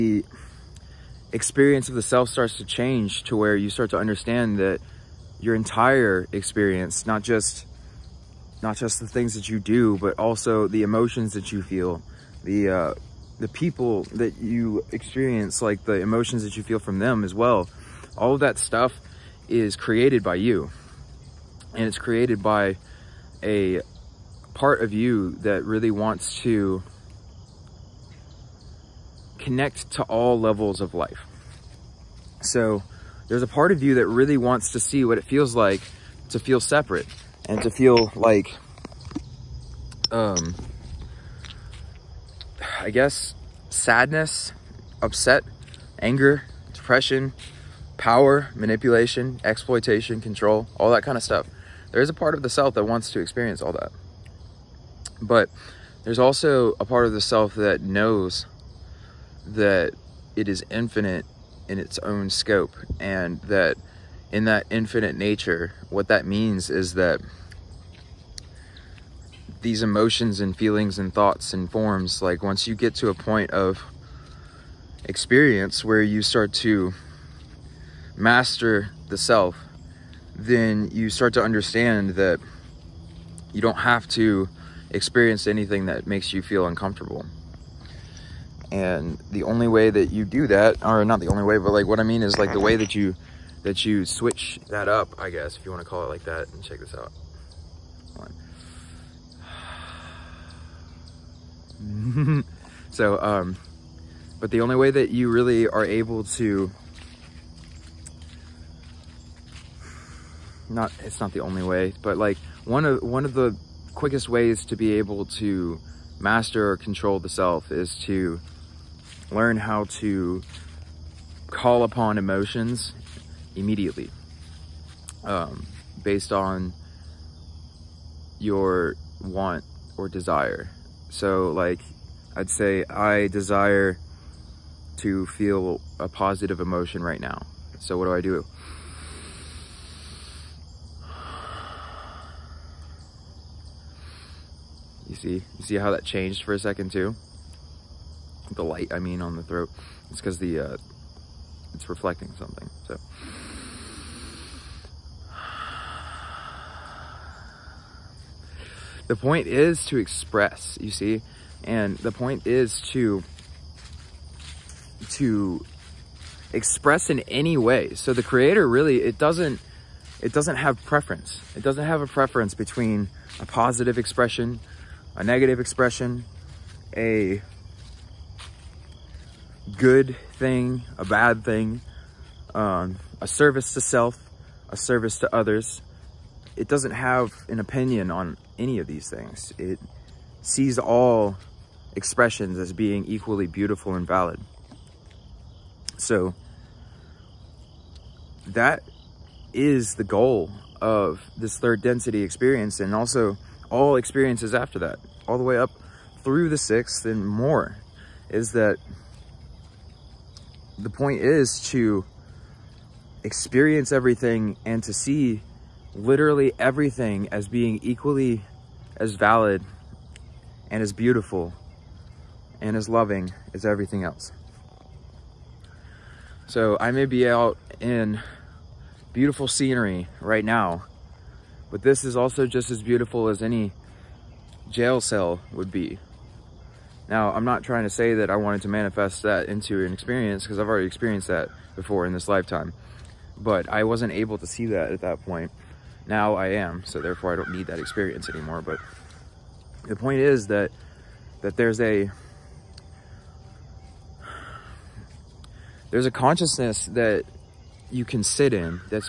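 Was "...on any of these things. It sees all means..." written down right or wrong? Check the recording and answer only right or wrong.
wrong.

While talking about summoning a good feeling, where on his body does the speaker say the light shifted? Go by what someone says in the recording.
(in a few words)
The throat.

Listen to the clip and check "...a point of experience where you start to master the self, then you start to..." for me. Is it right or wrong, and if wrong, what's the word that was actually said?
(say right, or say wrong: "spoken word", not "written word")
right.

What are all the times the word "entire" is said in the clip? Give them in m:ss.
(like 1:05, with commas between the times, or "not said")
0:05.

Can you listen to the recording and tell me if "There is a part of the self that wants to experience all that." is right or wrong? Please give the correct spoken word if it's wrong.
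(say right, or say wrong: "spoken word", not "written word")
right.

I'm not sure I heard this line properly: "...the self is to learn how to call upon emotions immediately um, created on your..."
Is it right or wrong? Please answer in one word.
wrong.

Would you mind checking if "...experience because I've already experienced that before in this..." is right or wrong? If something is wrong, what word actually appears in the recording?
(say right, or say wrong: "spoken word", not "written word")
right.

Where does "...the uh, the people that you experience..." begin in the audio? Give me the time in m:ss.
0:12.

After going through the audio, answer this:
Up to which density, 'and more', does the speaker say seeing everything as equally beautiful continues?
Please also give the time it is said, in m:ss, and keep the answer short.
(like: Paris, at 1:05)
The sixth, at 3:26.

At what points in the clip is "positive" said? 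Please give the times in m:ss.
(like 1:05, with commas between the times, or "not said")
2:16, 2:53.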